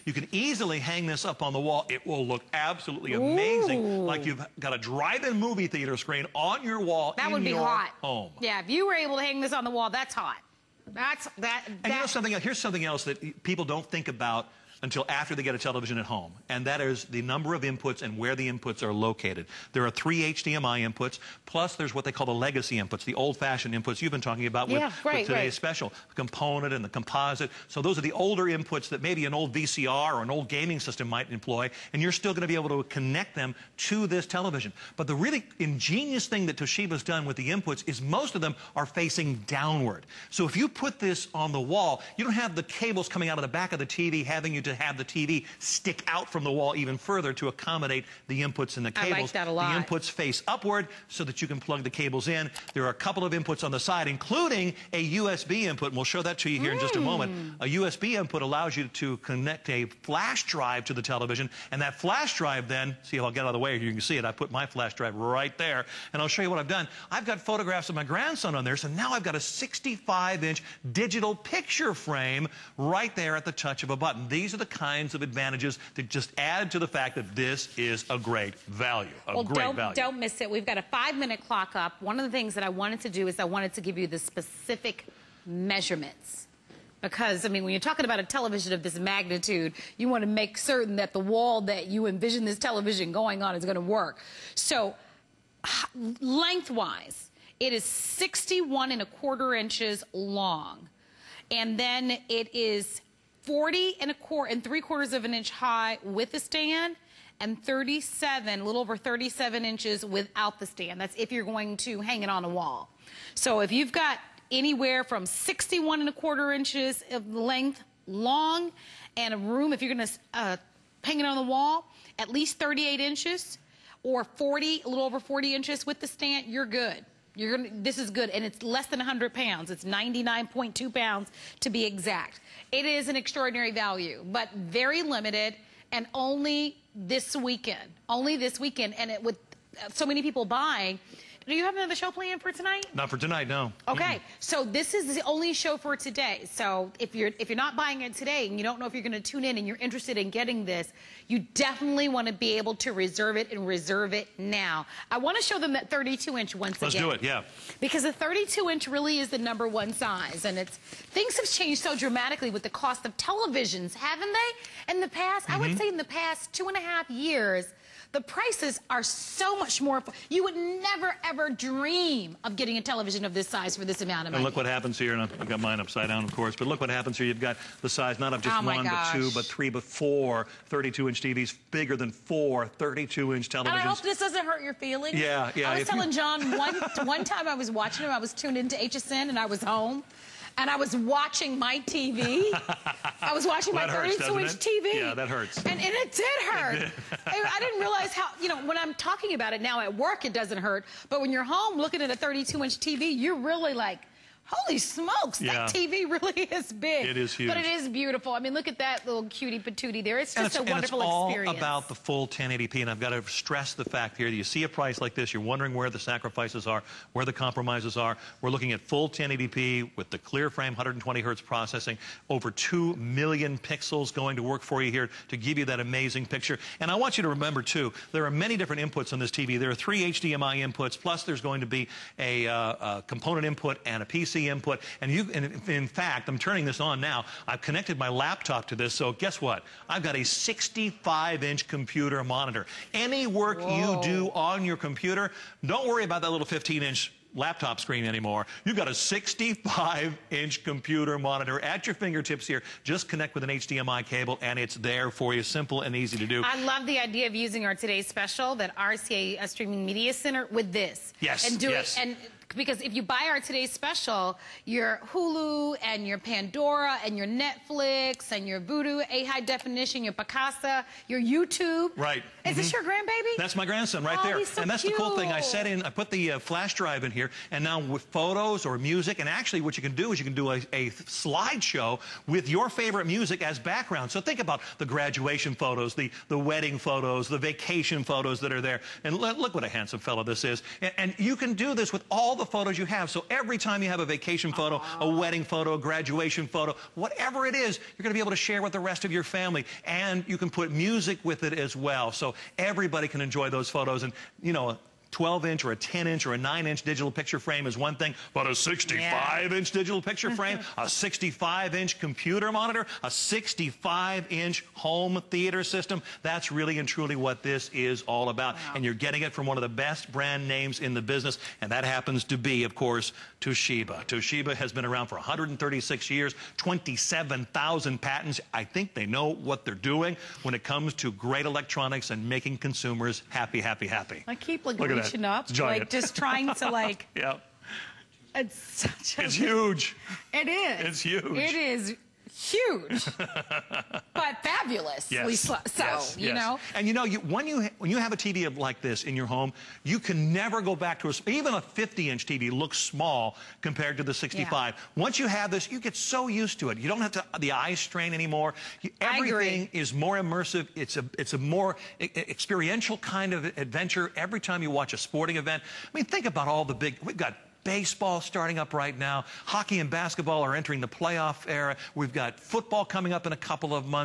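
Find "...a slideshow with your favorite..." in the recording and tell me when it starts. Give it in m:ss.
4:40.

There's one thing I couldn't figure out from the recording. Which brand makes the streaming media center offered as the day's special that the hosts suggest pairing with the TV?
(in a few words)
RCA.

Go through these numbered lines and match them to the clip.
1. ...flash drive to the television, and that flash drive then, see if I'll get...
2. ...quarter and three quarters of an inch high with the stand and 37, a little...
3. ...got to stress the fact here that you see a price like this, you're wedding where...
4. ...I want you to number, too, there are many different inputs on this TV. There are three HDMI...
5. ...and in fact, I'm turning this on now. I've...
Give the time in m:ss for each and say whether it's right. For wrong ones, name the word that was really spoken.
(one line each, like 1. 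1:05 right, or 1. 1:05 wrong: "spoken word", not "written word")
1. 1:00 right
2. 1:44 right
3. 3:32 wrong: "wondering", not "wedding"
4. 3:46 wrong: "remember", not "number"
5. 3:55 right.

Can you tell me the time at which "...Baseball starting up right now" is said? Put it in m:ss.
6:07.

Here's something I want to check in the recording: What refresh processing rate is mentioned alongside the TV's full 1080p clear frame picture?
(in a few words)
120 hertz.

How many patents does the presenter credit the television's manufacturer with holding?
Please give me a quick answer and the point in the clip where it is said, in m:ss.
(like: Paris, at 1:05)
27,000, at 5:26.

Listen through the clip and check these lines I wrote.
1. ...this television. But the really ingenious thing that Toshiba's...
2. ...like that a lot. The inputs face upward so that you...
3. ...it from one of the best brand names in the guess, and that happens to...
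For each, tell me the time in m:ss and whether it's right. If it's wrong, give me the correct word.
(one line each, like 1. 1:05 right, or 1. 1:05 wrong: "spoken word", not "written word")
1. 0:34 right
2. 0:49 right
3. 5:19 wrong: "business", not "guess".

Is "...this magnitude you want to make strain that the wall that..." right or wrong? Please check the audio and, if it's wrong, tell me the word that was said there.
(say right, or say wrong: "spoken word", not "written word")
wrong: "certain", not "strain".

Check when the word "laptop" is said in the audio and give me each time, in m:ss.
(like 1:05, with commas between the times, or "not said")
3:58, 4:07.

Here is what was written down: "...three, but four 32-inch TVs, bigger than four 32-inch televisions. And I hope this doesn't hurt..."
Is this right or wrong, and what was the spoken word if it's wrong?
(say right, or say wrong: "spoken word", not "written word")
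right.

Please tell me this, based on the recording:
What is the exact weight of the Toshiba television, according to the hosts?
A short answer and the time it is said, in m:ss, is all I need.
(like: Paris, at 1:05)
99.2 pounds, at 2:09.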